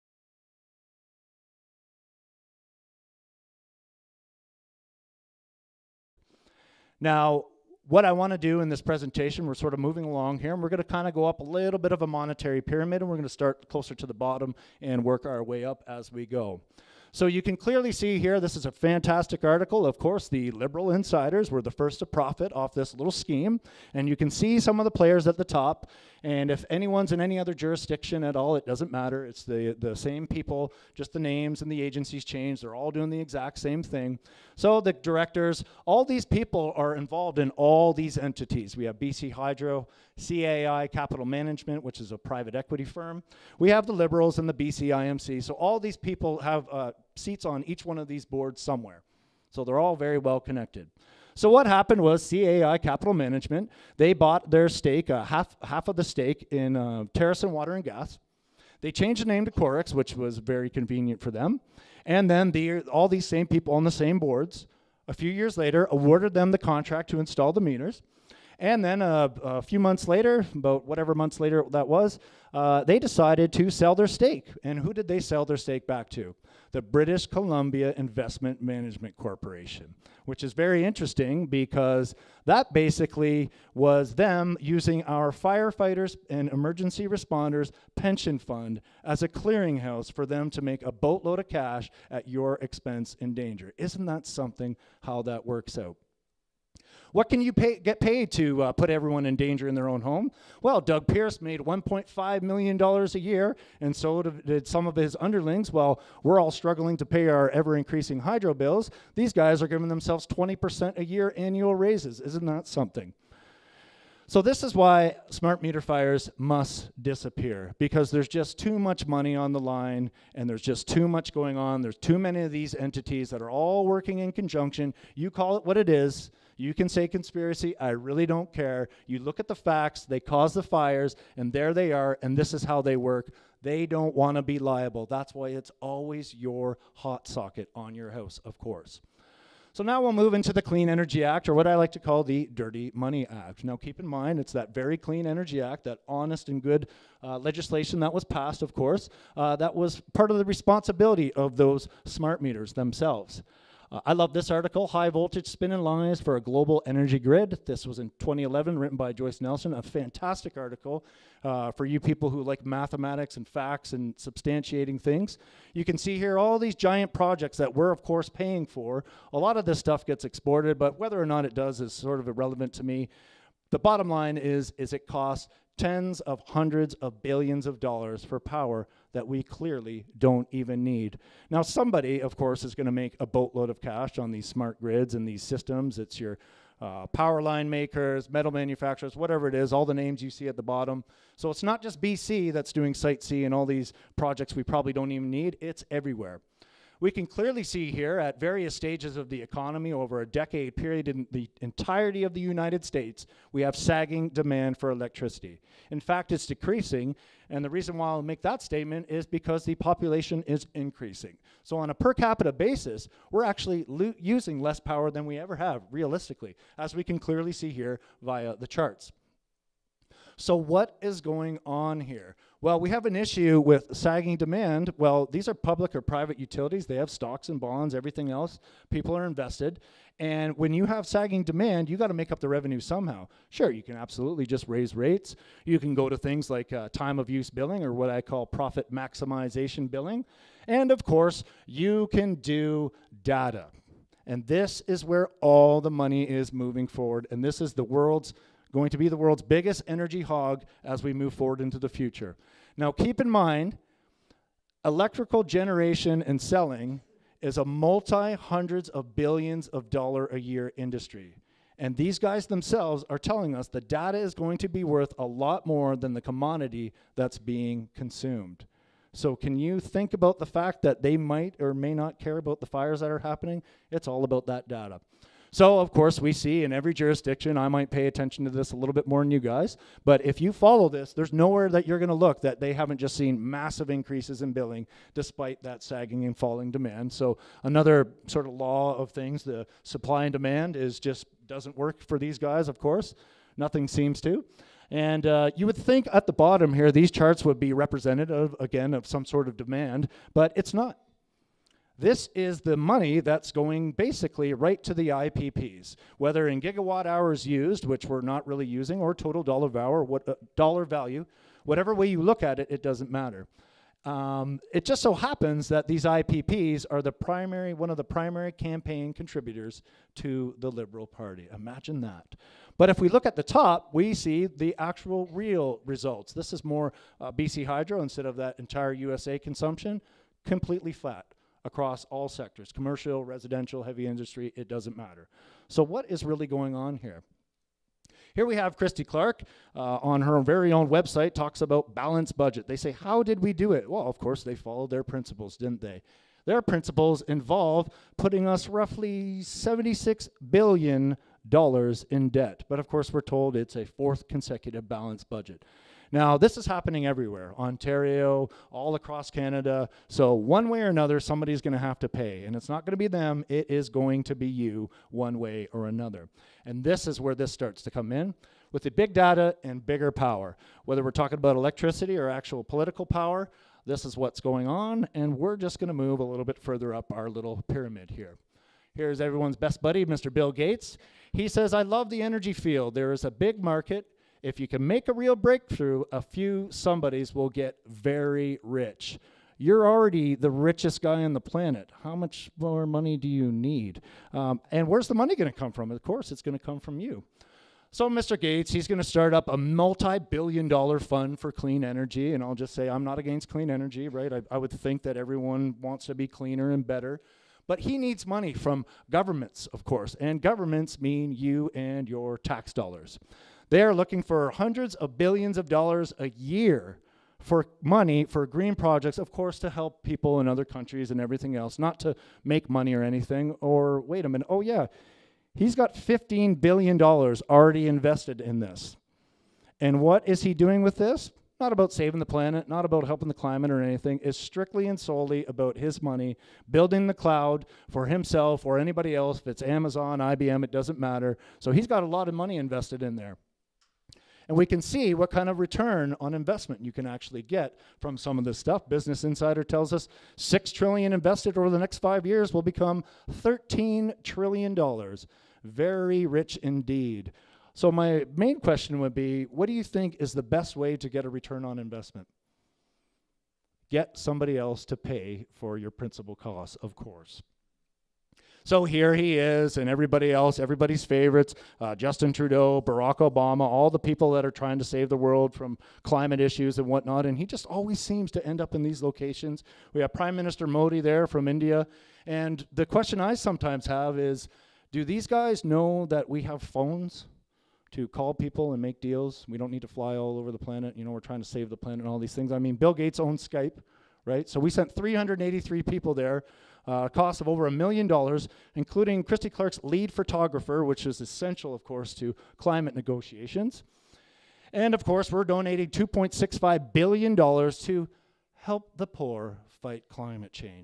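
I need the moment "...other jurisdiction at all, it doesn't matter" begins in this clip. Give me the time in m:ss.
0:27.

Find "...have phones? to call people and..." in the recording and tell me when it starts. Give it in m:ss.
8:06.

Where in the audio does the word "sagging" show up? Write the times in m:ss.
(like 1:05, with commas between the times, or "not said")
3:23, 3:43, 3:51, 4:45.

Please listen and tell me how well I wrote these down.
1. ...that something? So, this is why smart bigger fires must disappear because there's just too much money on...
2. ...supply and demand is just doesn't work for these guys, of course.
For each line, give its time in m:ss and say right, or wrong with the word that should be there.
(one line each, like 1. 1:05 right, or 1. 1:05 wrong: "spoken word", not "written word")
1. 1:52 wrong: "meter", not "bigger"
2. 4:49 right.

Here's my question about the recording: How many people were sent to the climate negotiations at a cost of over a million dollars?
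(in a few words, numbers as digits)
383.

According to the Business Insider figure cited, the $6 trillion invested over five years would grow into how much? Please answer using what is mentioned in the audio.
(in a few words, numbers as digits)
13 trillion dollars.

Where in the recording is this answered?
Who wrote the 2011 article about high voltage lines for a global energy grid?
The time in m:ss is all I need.
2:39.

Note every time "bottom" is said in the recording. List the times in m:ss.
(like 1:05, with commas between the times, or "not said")
0:14, 2:53, 3:10, 4:56.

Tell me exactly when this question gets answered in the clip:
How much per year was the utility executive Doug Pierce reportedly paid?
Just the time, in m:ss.
1:41.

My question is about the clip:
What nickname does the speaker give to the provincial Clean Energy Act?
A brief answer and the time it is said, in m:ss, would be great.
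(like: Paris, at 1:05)
Dirty Money Act, at 2:22.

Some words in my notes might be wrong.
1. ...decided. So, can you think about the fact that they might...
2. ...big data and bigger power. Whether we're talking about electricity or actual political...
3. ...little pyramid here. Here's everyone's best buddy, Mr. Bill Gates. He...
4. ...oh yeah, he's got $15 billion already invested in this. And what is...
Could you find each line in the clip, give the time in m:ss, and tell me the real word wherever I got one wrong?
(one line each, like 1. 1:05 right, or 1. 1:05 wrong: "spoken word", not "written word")
1. 4:27 wrong: "consumed", not "decided"
2. 6:08 right
3. 6:17 right
4. 7:04 right.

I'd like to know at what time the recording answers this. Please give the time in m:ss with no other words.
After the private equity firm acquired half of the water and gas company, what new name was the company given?
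0:59.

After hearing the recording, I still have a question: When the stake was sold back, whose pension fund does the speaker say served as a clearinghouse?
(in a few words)
firefighters and emergency responders.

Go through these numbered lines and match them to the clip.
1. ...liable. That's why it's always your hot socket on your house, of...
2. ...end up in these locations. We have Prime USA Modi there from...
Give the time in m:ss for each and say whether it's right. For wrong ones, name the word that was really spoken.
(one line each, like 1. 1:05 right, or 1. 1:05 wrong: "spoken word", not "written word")
1. 2:14 right
2. 7:58 wrong: "Minister", not "USA".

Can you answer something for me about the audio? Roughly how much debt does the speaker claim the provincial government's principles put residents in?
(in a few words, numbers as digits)
76 billion dollars.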